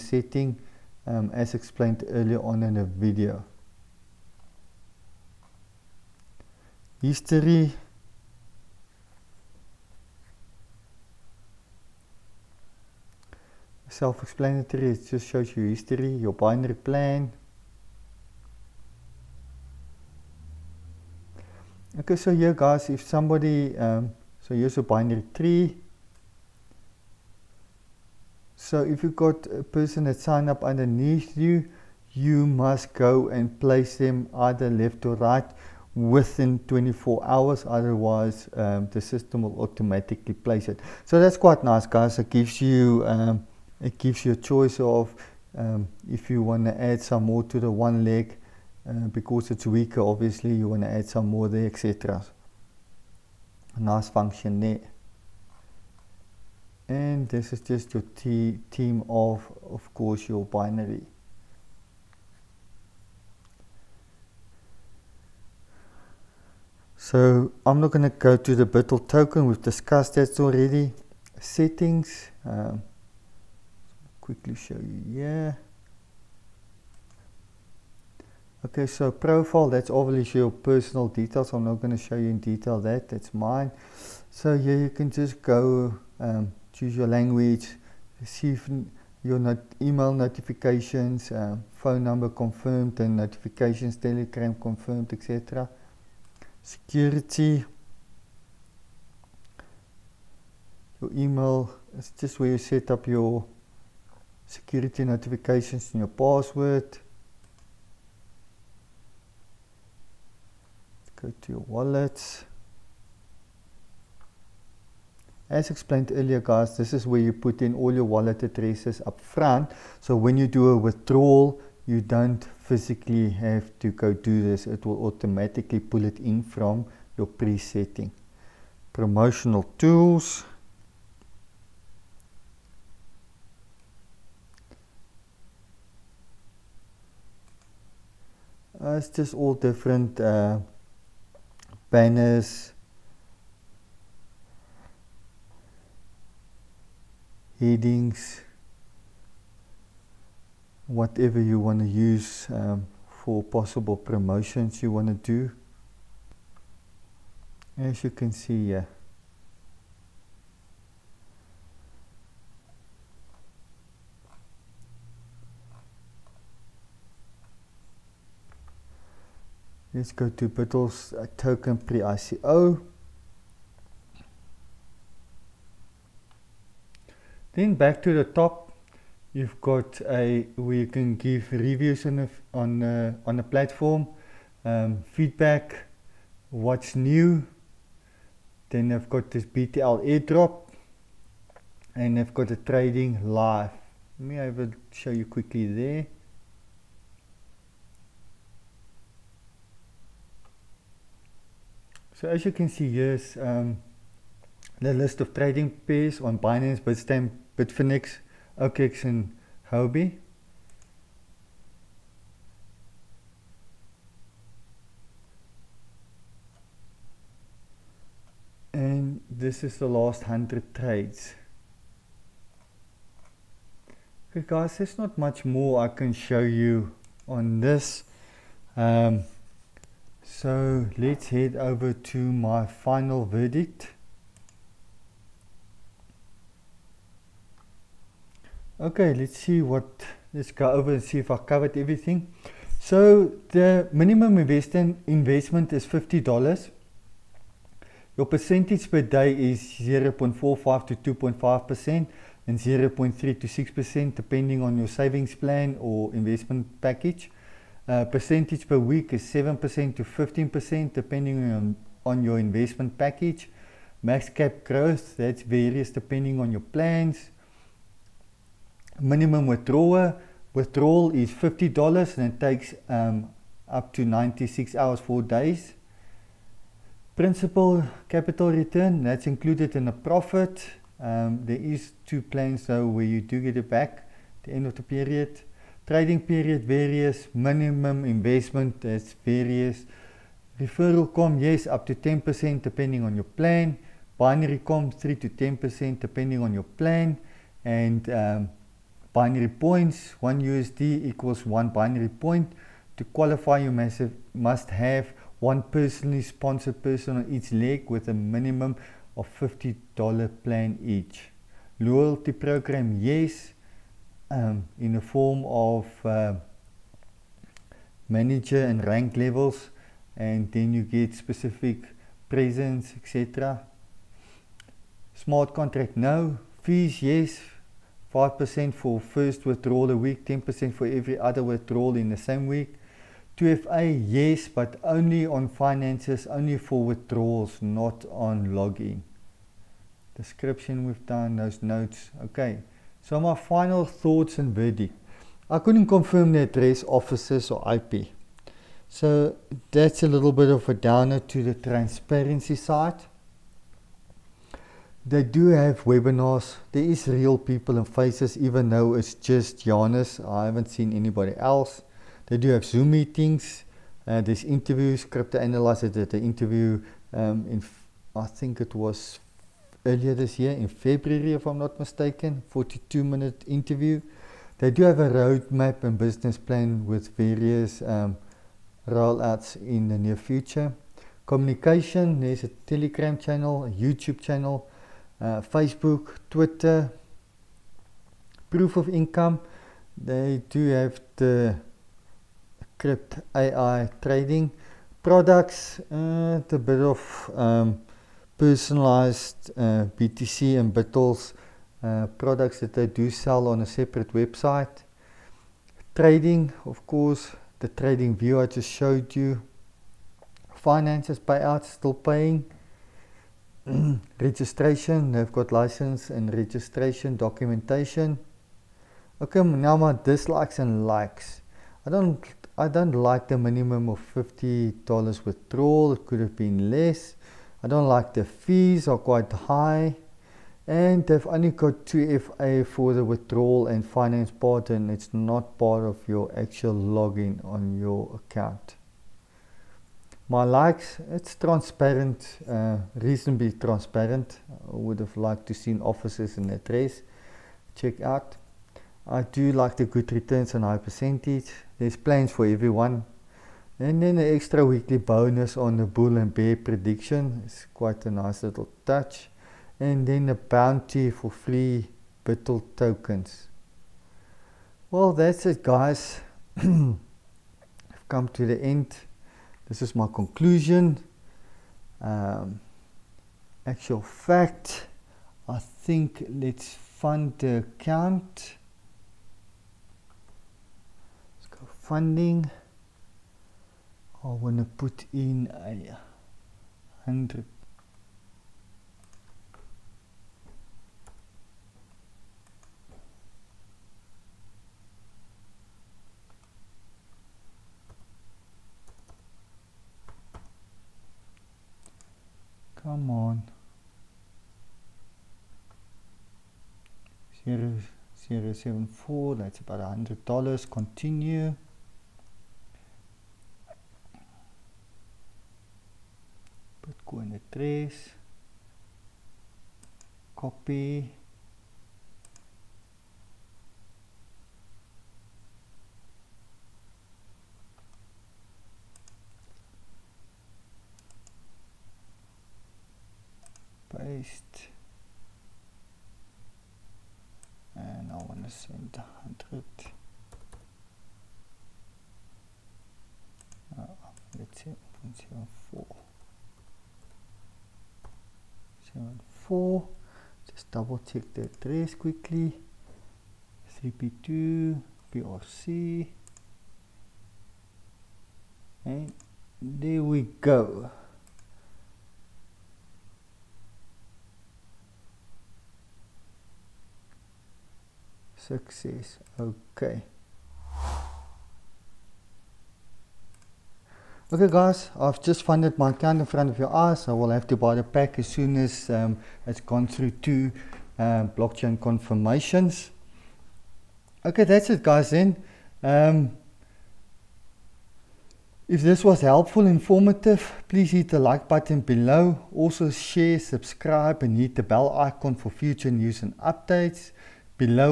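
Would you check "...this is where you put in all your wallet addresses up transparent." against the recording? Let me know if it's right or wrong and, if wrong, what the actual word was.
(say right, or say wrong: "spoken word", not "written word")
wrong: "front", not "transparent".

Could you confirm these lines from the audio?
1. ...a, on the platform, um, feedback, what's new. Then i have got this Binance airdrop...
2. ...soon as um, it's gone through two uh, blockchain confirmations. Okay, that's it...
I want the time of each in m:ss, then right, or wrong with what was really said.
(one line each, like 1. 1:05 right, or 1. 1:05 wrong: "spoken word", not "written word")
1. 3:02 wrong: "BTL", not "Binance"
2. 9:38 right.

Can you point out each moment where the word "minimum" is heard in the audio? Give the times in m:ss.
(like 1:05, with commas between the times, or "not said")
4:03, 4:29, 4:47, 5:08, 7:03.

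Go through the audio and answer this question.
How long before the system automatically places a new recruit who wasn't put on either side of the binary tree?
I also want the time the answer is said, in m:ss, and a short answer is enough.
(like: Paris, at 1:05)
24 hours, at 0:36.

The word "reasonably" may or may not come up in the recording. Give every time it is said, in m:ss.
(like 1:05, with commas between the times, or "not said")
7:22.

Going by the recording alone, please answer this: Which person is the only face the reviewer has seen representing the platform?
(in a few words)
Giannis.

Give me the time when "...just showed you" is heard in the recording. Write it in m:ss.
6:48.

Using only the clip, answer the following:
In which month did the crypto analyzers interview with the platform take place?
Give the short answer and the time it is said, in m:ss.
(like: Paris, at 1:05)
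February, at 6:10.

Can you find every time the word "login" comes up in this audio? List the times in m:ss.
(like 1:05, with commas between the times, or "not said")
5:38, 7:16.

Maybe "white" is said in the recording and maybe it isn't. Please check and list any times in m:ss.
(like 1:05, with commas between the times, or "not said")
not said.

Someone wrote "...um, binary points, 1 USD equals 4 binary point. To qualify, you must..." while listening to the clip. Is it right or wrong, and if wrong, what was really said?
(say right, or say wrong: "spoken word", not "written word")
wrong: "1", not "4".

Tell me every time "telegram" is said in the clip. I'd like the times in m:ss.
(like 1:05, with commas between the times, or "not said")
1:33, 6:22.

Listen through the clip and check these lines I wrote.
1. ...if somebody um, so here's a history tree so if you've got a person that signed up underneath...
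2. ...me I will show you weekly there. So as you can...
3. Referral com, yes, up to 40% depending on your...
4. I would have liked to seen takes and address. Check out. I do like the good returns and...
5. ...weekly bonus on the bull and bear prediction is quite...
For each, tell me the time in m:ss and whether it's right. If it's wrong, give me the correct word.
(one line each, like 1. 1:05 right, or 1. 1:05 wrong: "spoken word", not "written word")
1. 0:22 wrong: "binary", not "history"
2. 3:14 wrong: "quickly", not "weekly"
3. 4:50 wrong: "10", not "40"
4. 7:24 wrong: "offices", not "takes"
5. 7:34 right.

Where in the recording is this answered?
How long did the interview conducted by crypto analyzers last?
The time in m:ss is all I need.
6:12.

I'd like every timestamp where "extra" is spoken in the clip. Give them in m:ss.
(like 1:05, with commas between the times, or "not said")
7:34.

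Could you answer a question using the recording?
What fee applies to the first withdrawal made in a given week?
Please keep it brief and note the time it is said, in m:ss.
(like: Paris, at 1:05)
5%, at 5:28.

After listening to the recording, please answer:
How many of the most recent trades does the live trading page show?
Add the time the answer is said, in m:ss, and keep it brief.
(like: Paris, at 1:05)
100, at 3:39.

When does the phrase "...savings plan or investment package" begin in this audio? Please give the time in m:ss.
4:14.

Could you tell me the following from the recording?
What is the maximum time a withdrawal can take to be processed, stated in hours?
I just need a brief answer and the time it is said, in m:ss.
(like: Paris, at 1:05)
96 hours, at 4:34.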